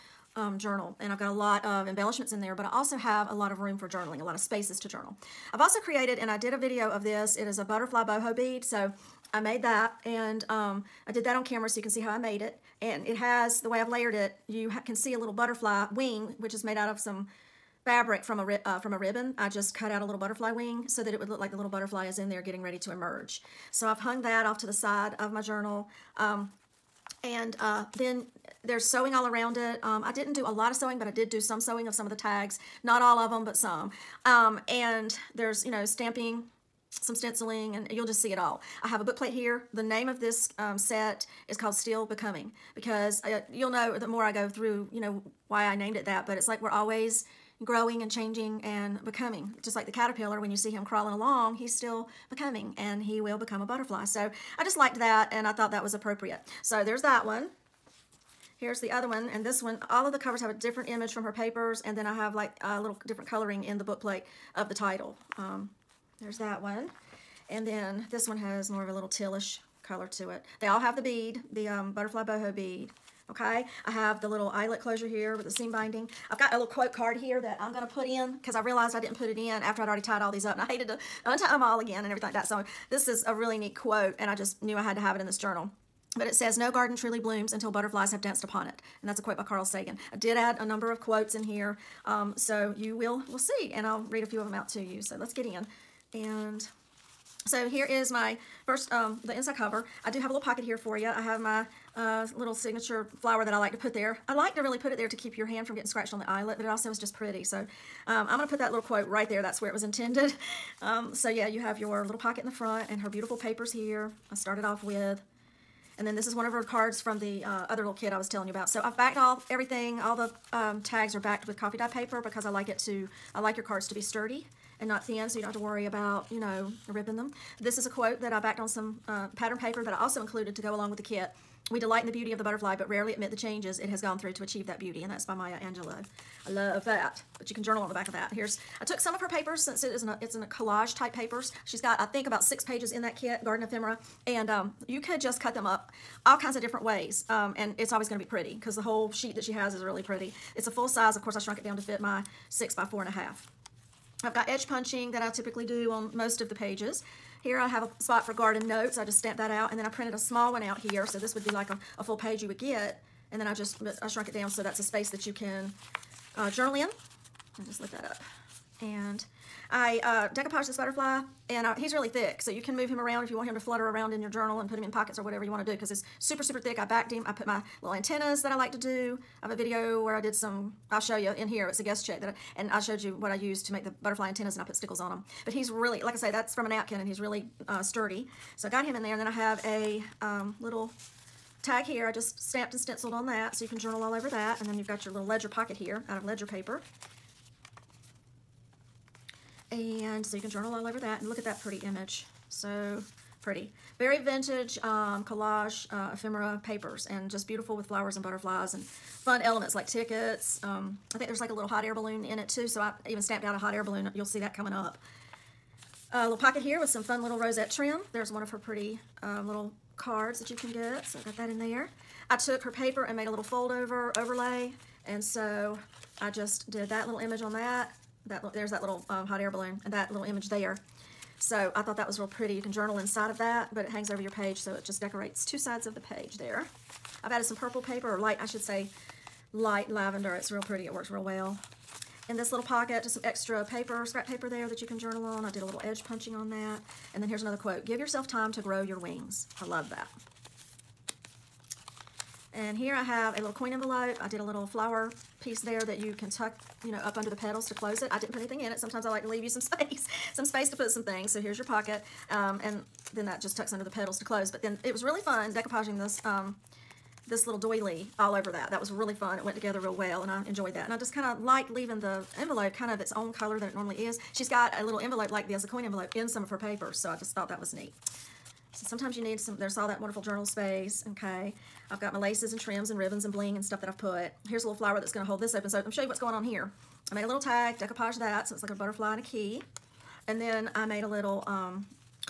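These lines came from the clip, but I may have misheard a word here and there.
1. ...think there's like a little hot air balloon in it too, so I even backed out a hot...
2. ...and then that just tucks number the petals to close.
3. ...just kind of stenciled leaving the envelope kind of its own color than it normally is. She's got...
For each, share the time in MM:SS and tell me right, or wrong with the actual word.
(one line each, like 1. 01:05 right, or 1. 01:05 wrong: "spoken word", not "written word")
1. 03:31 wrong: "snapped", not "backed"
2. 04:22 wrong: "under", not "number"
3. 04:30 wrong: "liked", not "stenciled".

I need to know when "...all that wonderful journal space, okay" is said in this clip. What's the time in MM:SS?
04:39.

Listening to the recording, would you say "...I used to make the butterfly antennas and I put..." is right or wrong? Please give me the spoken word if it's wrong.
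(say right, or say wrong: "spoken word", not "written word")
right.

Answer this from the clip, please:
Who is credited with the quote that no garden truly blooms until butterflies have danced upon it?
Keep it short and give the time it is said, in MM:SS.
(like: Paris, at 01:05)
Carl Sagan, at 01:29.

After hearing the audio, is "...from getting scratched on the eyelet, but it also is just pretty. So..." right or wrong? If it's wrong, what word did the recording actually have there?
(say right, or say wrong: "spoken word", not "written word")
right.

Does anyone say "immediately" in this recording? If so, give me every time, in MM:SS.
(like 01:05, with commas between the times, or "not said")
not said.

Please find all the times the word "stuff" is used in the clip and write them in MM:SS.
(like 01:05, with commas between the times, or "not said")
04:43.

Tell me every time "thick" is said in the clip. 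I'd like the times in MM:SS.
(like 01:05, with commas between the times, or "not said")
02:52, 02:56.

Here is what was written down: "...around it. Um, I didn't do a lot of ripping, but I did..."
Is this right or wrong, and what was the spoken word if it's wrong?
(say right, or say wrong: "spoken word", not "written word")
wrong: "sewing", not "ripping".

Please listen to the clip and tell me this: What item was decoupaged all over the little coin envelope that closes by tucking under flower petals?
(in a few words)
doily.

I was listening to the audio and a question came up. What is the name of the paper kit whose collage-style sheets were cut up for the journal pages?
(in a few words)
Garden Ephemera.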